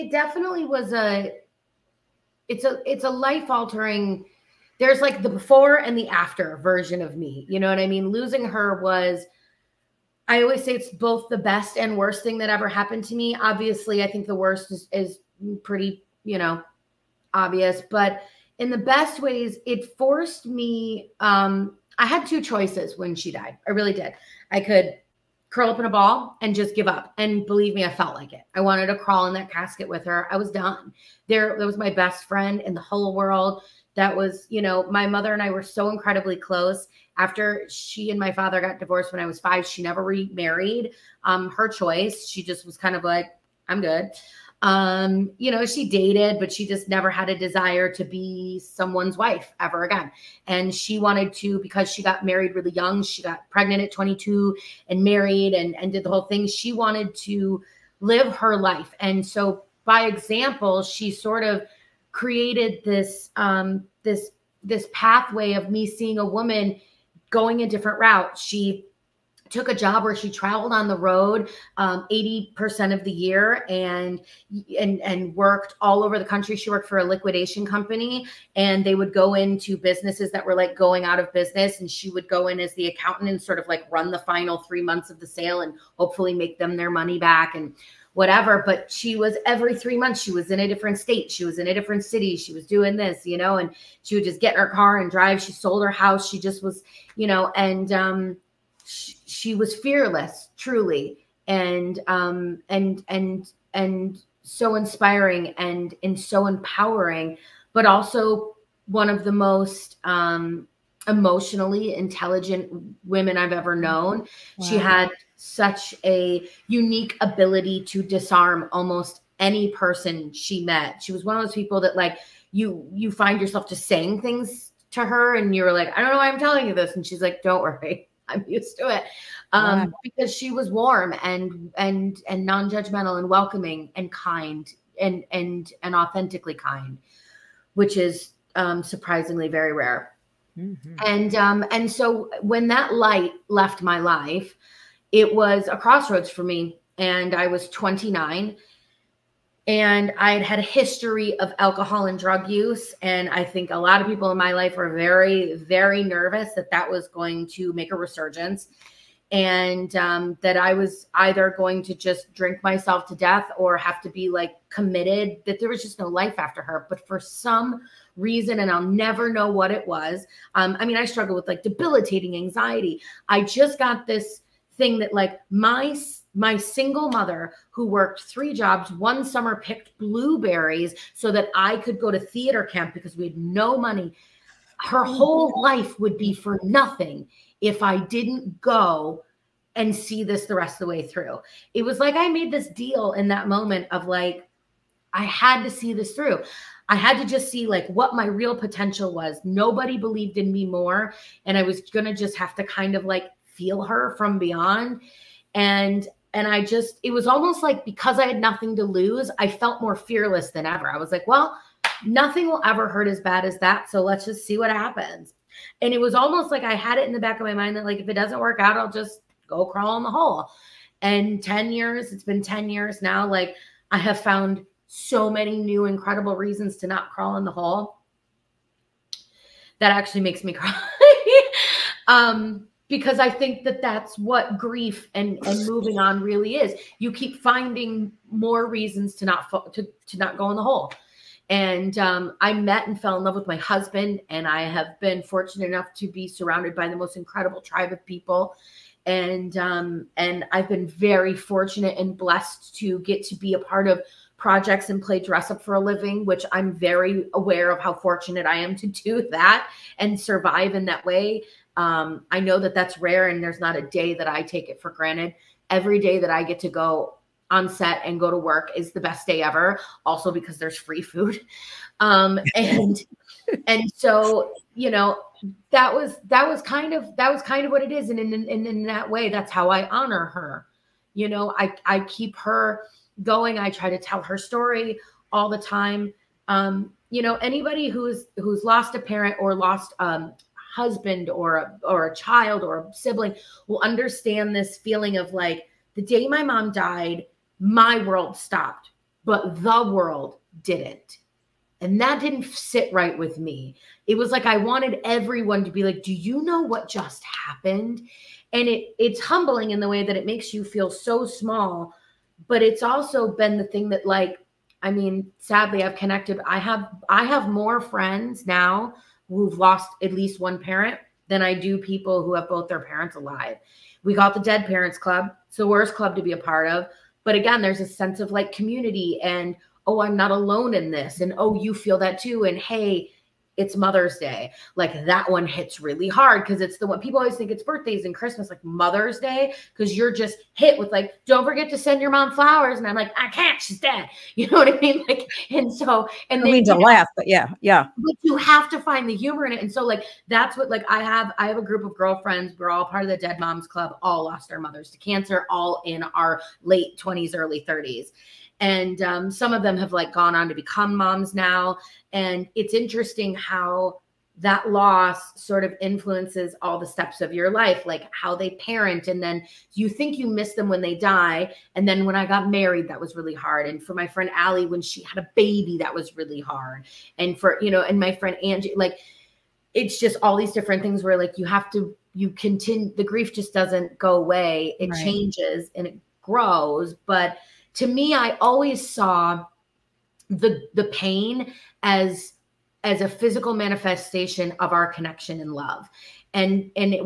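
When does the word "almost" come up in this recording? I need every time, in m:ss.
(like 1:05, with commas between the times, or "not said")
1:58, 3:27, 3:36.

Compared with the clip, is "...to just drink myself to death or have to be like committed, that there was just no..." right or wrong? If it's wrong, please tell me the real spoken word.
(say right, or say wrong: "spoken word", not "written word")
right.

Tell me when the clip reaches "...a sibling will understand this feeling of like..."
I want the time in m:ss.
4:52.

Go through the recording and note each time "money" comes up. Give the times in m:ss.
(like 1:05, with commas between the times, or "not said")
1:26, 3:03.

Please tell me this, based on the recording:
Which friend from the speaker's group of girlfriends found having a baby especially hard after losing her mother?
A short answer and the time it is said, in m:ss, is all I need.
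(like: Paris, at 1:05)
Allie, at 6:14.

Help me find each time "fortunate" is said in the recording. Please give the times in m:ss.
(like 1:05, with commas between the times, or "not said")
4:05, 4:11, 4:17.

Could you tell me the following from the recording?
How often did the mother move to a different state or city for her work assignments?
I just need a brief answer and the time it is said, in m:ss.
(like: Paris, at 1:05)
every three months, at 1:29.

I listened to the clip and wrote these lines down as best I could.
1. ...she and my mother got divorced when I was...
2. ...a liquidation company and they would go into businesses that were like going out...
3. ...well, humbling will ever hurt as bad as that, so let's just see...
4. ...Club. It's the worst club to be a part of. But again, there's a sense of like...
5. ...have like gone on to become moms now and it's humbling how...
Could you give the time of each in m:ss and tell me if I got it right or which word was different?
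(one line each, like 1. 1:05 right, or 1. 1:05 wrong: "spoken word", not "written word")
1. 0:37 wrong: "father", not "mother"
2. 1:16 right
3. 3:31 wrong: "nothing", not "humbling"
4. 5:24 right
5. 5:59 wrong: "interesting", not "humbling".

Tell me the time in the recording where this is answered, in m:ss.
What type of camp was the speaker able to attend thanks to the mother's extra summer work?
3:02.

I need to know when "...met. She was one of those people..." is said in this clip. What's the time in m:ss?
2:00.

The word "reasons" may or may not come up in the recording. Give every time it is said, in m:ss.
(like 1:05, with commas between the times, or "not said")
2:48, 3:46, 3:58.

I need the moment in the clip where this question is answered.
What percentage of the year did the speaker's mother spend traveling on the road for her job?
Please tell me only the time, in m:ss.
1:11.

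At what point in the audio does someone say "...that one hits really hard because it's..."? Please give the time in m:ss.
5:35.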